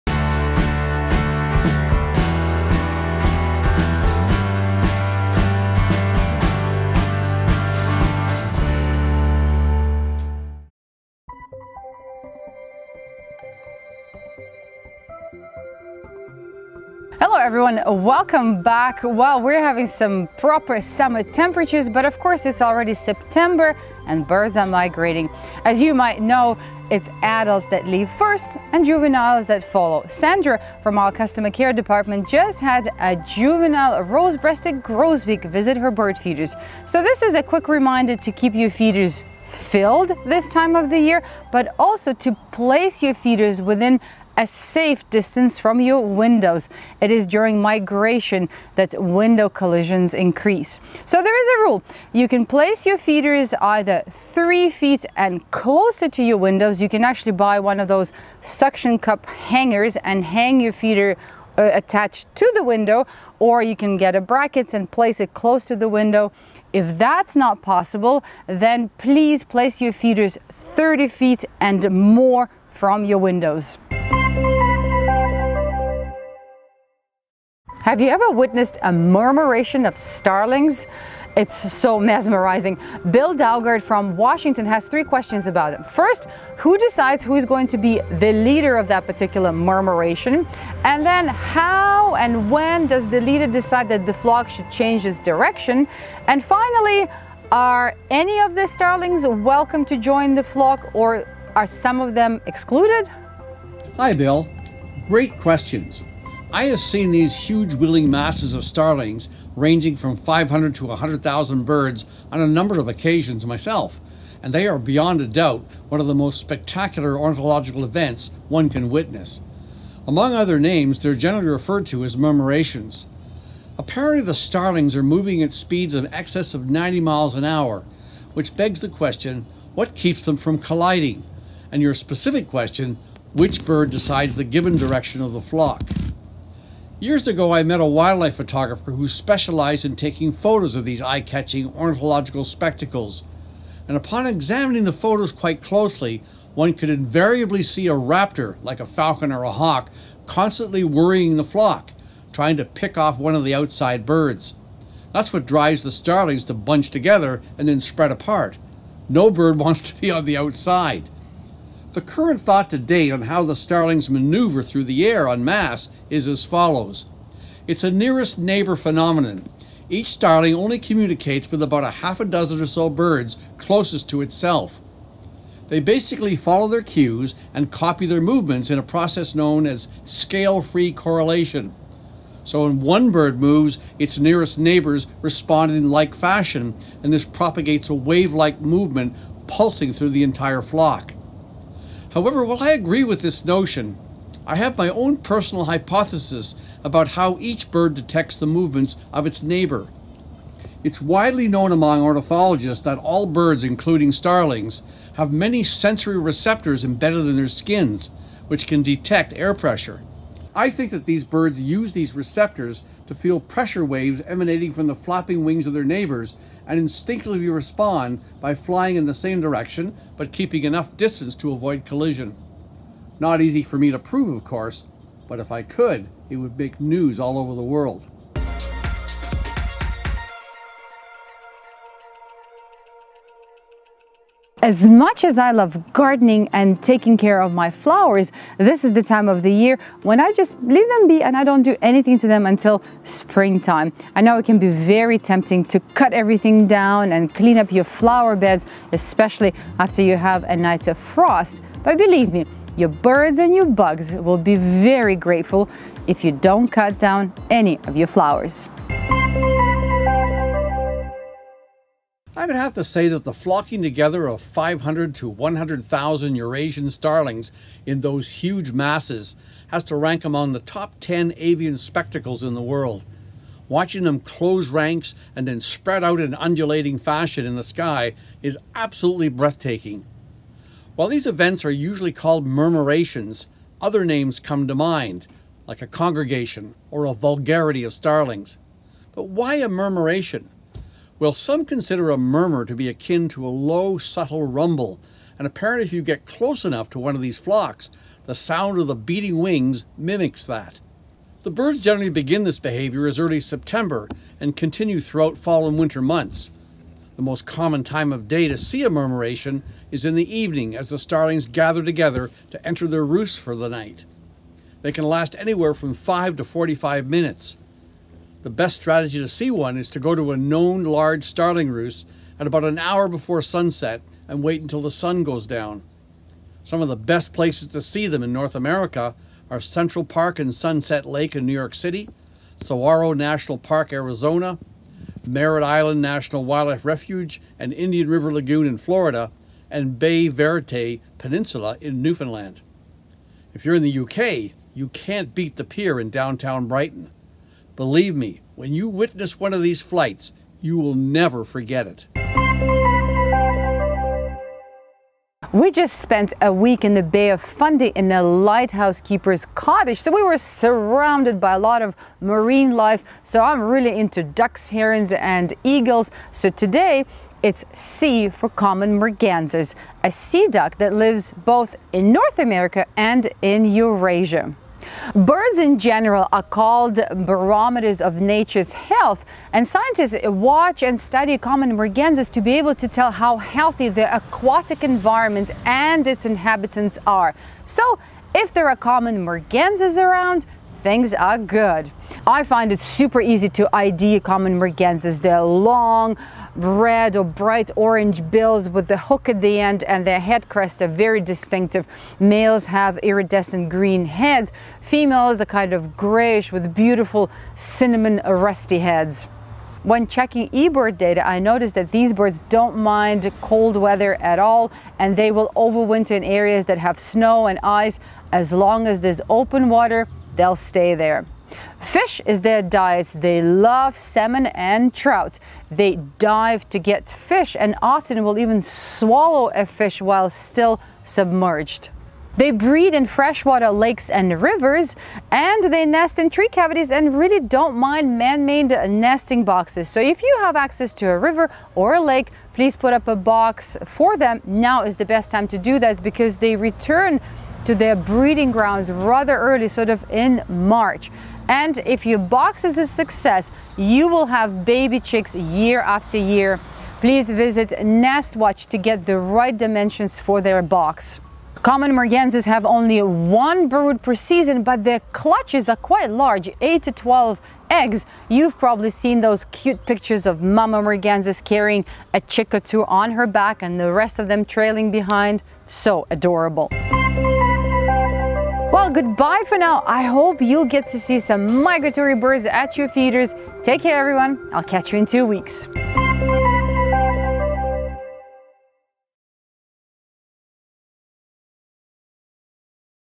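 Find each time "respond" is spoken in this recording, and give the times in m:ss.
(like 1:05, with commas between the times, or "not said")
3:05, 3:37.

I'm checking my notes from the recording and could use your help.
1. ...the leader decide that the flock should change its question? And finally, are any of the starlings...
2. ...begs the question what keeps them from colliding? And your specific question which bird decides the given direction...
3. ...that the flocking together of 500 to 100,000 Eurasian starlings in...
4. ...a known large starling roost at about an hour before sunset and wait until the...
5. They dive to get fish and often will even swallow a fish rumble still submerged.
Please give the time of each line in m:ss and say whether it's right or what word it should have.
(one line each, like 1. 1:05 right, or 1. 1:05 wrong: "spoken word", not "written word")
1. 1:33 wrong: "direction", not "question"
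2. 2:08 right
3. 4:23 right
4. 5:20 right
5. 7:05 wrong: "while", not "rumble".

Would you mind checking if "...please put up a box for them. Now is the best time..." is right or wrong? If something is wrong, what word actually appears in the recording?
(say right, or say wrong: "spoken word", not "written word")
right.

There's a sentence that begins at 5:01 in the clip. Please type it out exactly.
The birds generally begin this behavior as early as September and continue throughout fall and winter months.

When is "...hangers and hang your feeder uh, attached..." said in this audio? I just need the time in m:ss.
0:59.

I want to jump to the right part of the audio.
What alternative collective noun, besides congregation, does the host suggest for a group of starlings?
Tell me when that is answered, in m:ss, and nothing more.
4:47.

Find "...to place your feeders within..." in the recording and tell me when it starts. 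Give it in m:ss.
0:42.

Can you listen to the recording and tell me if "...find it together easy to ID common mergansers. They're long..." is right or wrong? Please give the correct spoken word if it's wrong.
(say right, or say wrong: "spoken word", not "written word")
wrong: "super", not "together".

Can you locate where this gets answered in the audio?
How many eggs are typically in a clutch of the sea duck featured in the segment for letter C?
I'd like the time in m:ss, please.
7:46.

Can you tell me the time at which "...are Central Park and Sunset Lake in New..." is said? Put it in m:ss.
5:29.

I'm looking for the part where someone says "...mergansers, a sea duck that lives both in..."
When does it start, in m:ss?
6:08.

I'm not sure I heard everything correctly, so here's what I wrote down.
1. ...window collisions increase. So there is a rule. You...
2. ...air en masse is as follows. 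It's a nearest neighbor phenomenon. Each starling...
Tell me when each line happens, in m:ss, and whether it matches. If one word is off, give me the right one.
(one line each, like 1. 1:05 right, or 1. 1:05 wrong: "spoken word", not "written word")
1. 0:49 right
2. 2:45 right.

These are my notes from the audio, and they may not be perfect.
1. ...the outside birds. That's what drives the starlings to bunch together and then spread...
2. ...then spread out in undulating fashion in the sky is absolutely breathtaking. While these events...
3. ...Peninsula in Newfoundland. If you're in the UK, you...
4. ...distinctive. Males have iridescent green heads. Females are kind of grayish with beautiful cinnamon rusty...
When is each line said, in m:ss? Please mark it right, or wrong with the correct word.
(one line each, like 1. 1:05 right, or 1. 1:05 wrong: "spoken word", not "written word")
1. 2:33 right
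2. 4:35 right
3. 5:41 right
4. 6:41 right.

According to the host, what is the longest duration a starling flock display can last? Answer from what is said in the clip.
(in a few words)
45 minutes.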